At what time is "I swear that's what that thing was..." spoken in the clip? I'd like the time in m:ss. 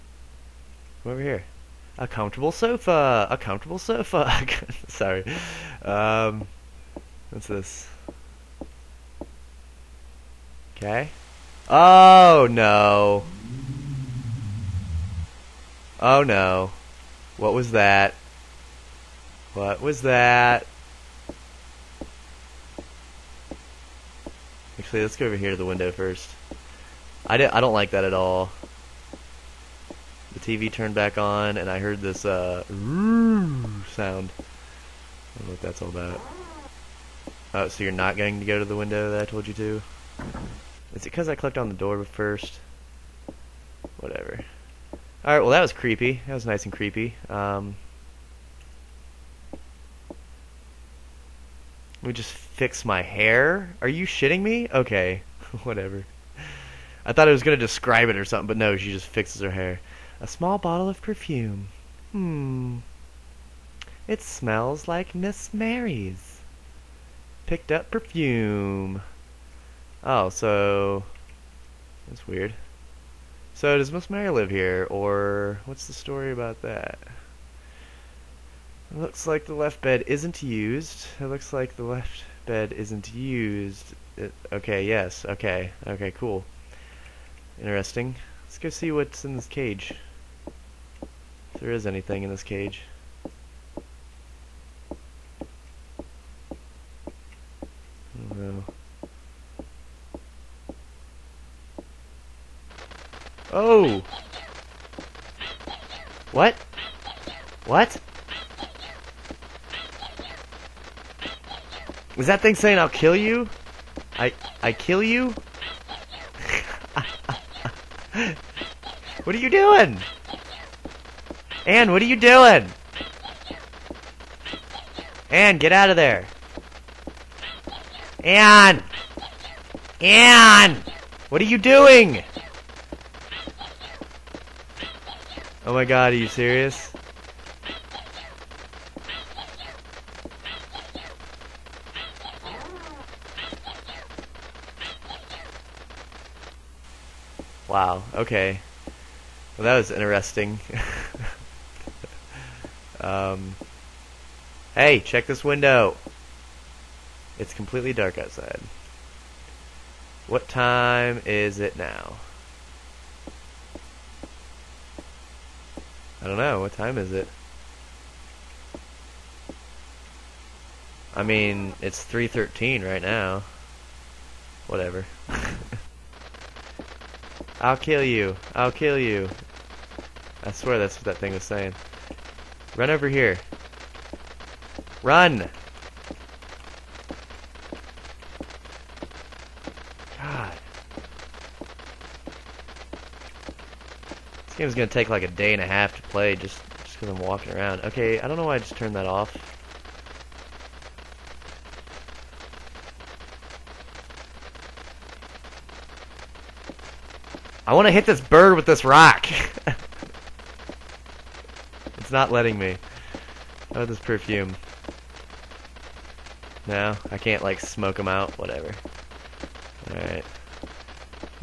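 3:00.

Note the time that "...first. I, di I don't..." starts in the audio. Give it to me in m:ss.
0:25.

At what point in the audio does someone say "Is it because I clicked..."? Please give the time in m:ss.
0:40.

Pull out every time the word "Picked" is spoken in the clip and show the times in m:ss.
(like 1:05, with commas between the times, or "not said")
1:07.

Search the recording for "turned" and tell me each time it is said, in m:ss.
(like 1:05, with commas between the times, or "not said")
0:30, 3:18.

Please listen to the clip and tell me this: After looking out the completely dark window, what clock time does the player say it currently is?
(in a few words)
3:13.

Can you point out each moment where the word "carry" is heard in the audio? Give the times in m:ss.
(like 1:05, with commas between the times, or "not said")
not said.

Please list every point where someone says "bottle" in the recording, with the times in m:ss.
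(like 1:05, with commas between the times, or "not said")
1:00.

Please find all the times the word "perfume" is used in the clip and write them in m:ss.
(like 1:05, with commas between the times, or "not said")
1:00, 1:07, 3:33.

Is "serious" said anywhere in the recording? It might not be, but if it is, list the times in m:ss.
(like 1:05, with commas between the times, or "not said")
2:16.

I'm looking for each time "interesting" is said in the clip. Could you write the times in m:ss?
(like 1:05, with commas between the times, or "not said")
1:27, 2:29.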